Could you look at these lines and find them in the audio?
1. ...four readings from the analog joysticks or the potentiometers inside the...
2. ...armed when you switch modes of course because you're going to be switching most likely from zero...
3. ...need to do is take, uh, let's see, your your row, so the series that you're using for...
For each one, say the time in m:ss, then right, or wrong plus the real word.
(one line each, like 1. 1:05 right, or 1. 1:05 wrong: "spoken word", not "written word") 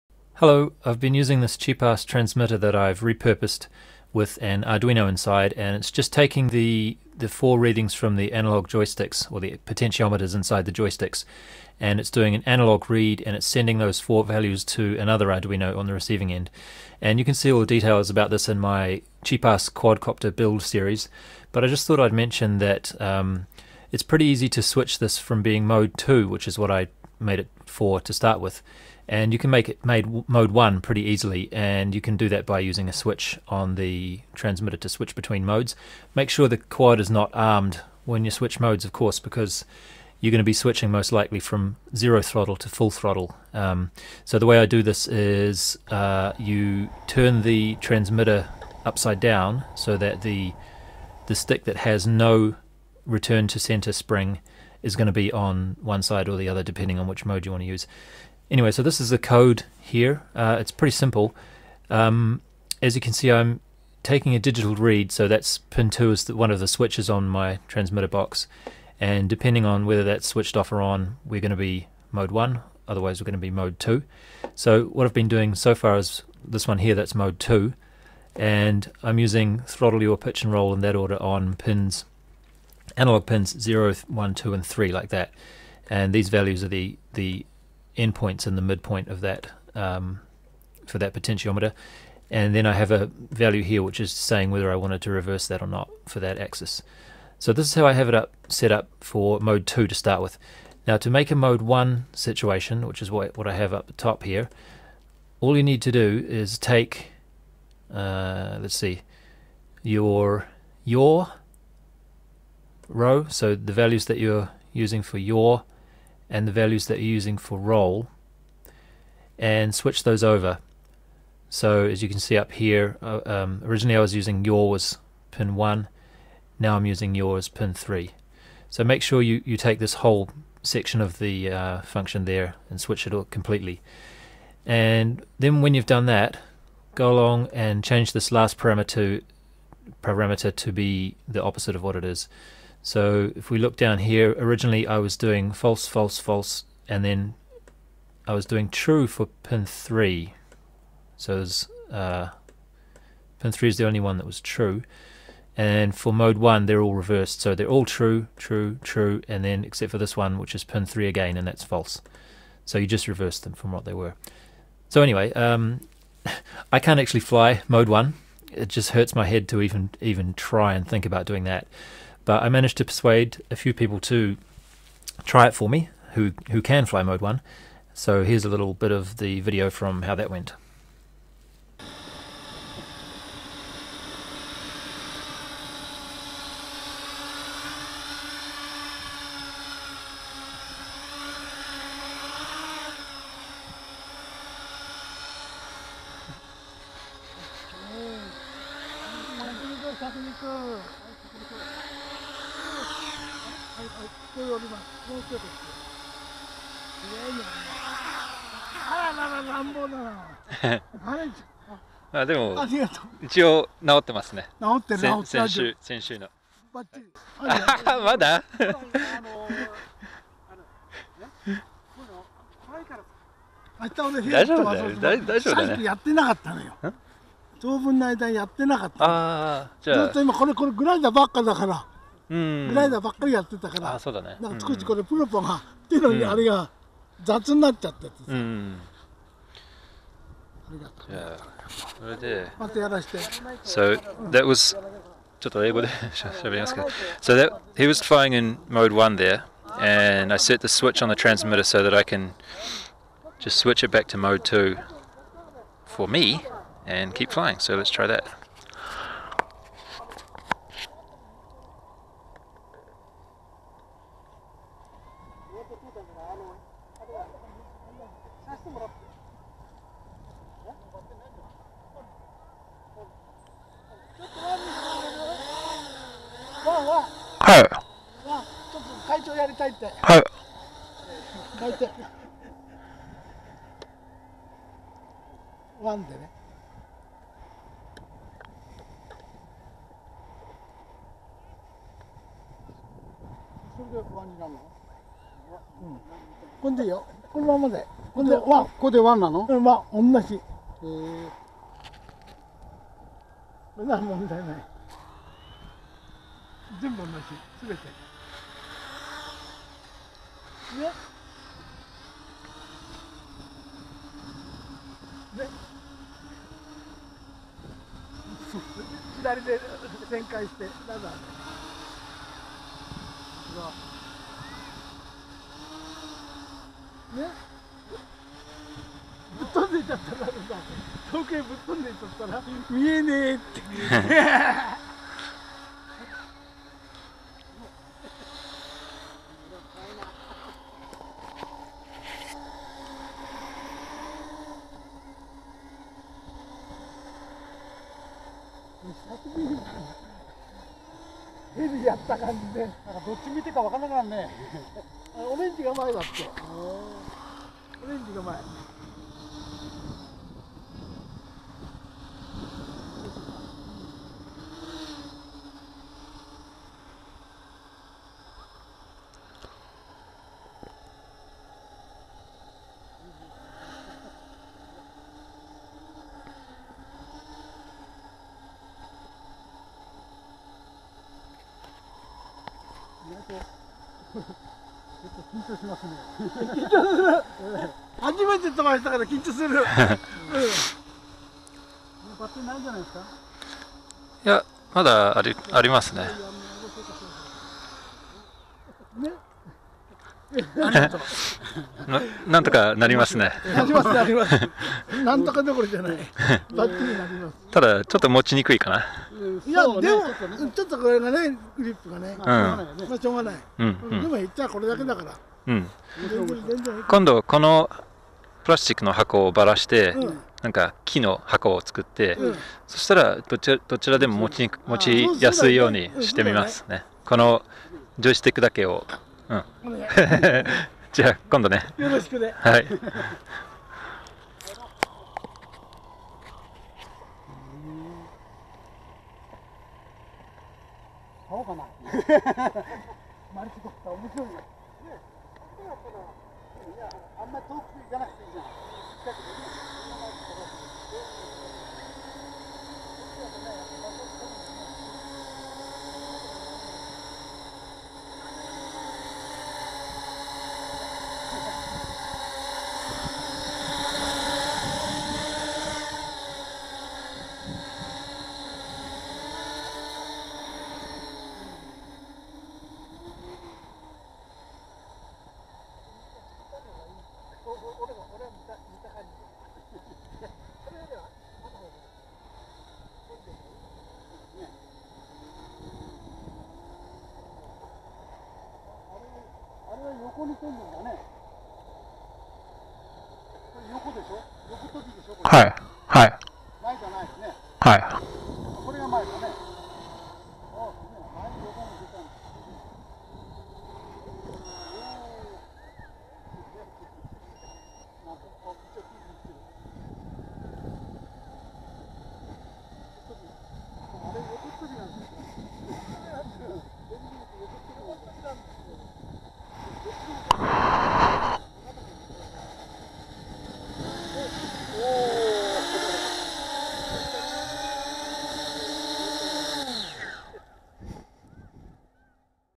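1. 0:07 right
2. 0:37 right
3. 1:45 wrong: "values", not "series".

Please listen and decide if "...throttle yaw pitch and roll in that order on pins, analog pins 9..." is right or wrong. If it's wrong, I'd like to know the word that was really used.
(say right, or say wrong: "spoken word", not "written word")
wrong: "0", not "9".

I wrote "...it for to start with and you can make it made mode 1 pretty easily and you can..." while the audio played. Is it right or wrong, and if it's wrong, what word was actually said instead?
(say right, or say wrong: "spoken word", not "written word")
right.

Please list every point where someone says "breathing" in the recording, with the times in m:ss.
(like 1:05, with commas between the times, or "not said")
not said.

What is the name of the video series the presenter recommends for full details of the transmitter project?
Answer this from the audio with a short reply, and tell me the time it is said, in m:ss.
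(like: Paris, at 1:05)
Cheap ass quadcopter build, at 0:19.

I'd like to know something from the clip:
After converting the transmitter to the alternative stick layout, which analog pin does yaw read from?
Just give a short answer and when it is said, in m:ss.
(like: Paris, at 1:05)
Pin 3, at 2:07.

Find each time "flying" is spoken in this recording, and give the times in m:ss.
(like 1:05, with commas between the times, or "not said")
4:08, 4:17.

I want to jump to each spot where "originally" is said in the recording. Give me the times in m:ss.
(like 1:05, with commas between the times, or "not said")
2:03, 2:24.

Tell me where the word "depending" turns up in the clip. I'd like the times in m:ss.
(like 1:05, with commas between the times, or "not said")
0:56, 1:09.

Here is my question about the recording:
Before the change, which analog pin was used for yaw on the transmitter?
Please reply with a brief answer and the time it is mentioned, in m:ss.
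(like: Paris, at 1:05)
Pin 1, at 2:04.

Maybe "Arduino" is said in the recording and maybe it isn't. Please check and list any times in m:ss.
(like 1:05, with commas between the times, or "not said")
0:04, 0:15.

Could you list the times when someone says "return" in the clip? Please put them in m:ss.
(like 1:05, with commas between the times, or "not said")
0:53.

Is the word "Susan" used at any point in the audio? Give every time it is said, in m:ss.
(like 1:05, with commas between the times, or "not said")
not said.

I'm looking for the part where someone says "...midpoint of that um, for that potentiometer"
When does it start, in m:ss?
1:28.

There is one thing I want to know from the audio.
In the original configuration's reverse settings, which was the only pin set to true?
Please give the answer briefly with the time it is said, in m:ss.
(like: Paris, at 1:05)
Pin 3, at 2:33.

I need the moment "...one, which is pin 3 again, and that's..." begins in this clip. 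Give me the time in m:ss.
2:40.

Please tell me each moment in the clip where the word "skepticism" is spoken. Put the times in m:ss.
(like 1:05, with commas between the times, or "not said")
not said.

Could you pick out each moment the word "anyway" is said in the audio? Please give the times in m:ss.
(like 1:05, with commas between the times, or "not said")
0:58, 2:45.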